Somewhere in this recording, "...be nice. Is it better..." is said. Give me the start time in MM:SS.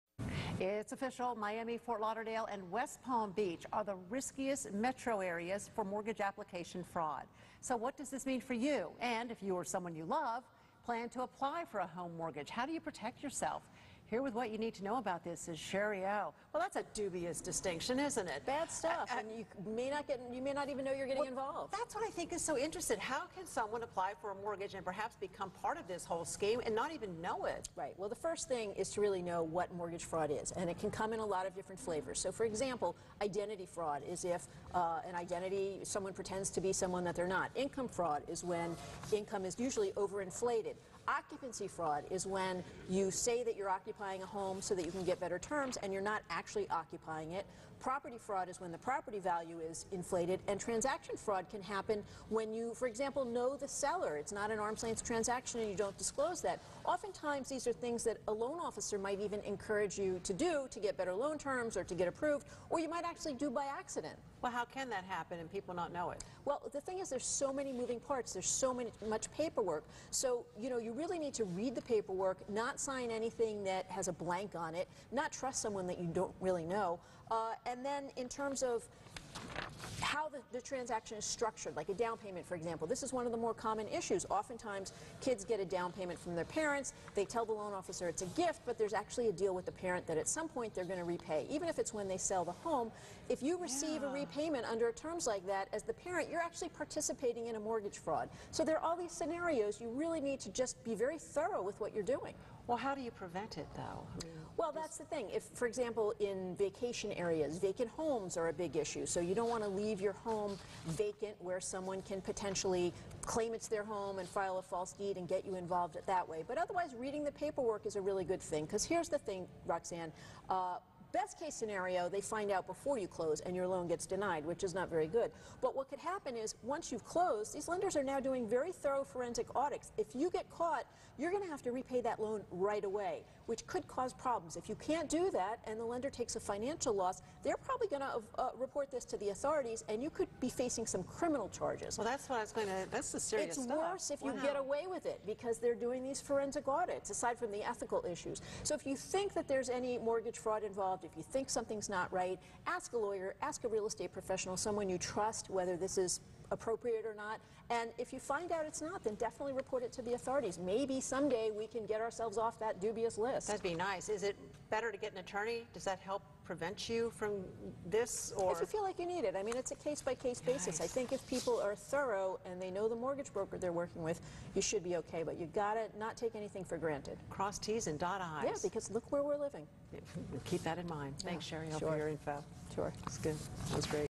02:43.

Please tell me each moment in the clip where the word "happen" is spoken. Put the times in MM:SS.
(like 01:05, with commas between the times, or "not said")
00:51, 01:05, 02:05.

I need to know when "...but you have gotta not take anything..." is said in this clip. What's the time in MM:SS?
02:55.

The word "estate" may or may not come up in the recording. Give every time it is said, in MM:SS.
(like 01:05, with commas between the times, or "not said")
02:33.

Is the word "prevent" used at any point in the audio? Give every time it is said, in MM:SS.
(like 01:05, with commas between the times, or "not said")
01:43, 02:46.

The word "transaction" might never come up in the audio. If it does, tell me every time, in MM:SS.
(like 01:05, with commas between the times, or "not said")
00:50, 00:55, 01:20.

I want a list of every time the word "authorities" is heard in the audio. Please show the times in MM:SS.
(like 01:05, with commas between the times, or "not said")
02:19, 02:40.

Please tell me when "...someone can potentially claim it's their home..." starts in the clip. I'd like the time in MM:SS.
01:51.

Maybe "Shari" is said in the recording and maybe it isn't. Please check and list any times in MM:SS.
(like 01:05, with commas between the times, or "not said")
00:15, 03:01.